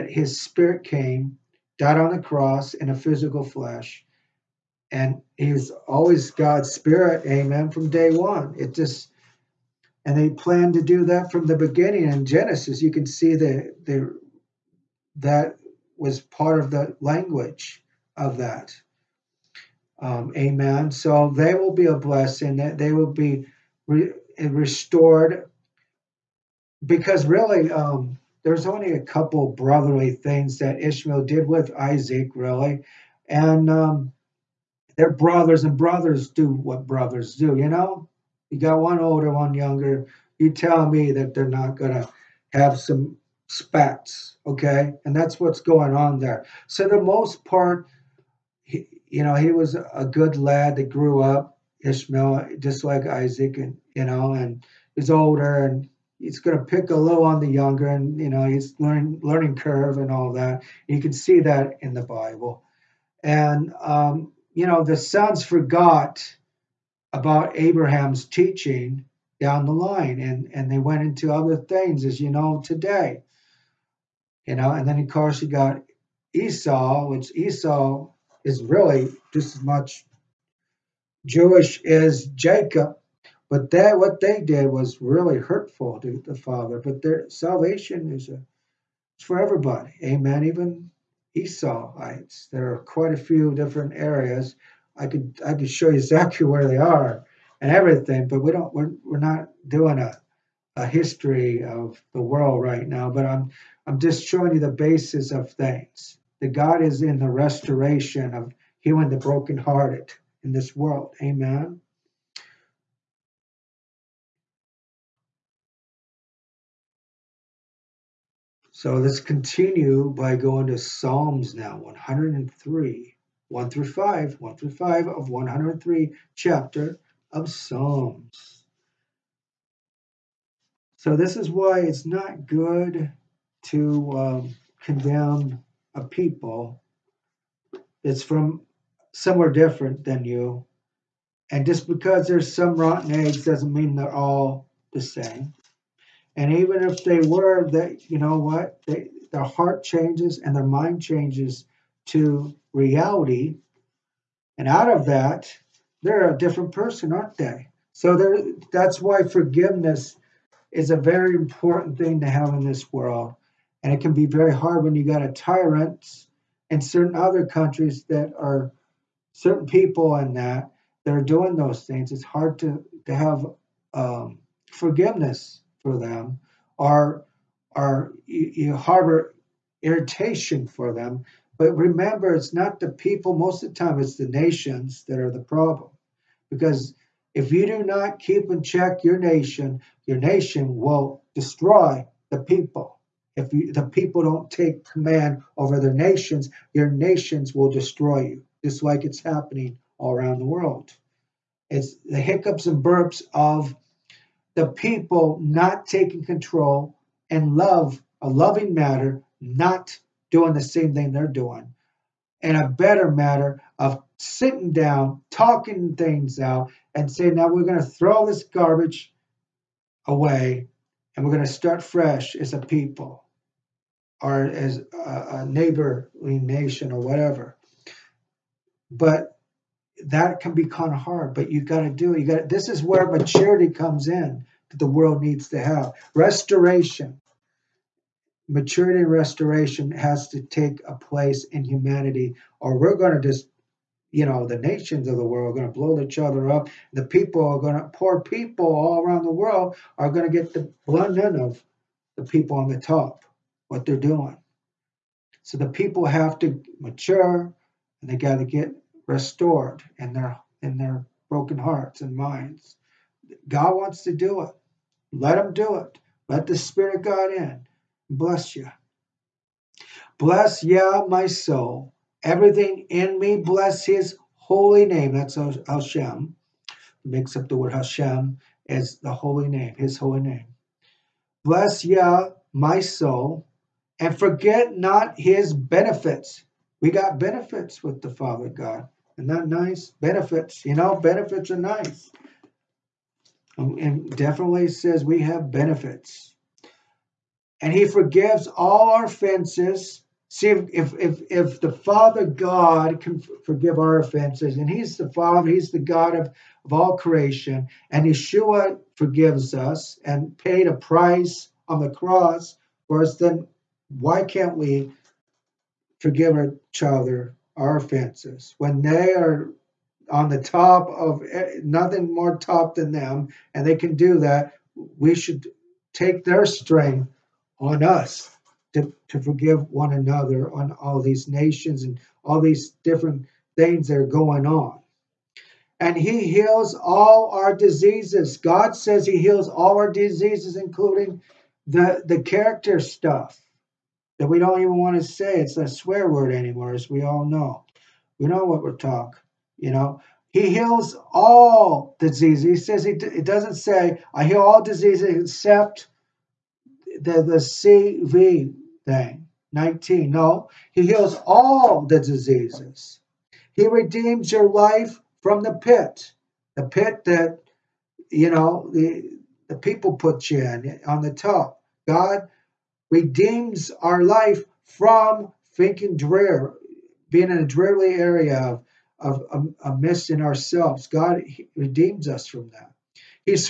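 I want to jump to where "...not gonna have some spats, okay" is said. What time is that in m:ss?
0:41.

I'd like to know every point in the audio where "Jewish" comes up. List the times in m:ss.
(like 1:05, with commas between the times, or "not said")
1:21.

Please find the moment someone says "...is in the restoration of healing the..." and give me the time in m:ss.
1:46.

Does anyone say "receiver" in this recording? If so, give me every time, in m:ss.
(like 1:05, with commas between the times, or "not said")
not said.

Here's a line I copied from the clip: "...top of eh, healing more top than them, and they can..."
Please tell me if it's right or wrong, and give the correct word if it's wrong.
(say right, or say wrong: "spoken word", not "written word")
wrong: "nothing", not "healing".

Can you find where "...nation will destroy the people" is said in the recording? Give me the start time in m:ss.
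3:10.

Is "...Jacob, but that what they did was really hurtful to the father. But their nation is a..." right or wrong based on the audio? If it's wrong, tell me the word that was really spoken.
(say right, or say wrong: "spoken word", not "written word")
wrong: "salvation", not "nation".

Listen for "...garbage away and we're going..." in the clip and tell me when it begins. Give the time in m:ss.
3:38.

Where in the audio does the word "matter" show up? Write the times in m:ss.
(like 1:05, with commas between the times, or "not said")
3:28, 3:33.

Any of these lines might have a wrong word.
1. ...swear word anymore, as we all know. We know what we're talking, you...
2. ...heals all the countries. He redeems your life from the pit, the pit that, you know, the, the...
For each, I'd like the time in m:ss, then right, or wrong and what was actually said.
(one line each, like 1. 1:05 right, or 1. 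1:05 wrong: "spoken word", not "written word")
1. 5:45 right
2. 6:00 wrong: "diseases", not "countries".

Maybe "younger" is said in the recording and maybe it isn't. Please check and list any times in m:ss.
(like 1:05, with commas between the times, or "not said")
0:39, 0:57.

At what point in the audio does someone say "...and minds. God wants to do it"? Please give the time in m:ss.
4:22.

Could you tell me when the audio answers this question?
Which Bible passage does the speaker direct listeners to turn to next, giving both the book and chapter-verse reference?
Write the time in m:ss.
2:00.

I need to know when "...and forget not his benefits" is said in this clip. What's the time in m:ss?
4:43.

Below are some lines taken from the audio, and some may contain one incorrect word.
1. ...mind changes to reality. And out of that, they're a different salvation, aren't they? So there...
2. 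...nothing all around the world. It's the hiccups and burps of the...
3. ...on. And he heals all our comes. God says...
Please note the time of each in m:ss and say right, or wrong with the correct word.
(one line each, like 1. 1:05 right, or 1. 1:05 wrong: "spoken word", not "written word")
1. 2:30 wrong: "person", not "salvation"
2. 3:19 wrong: "happening", not "nothing"
3. 5:34 wrong: "diseases", not "comes".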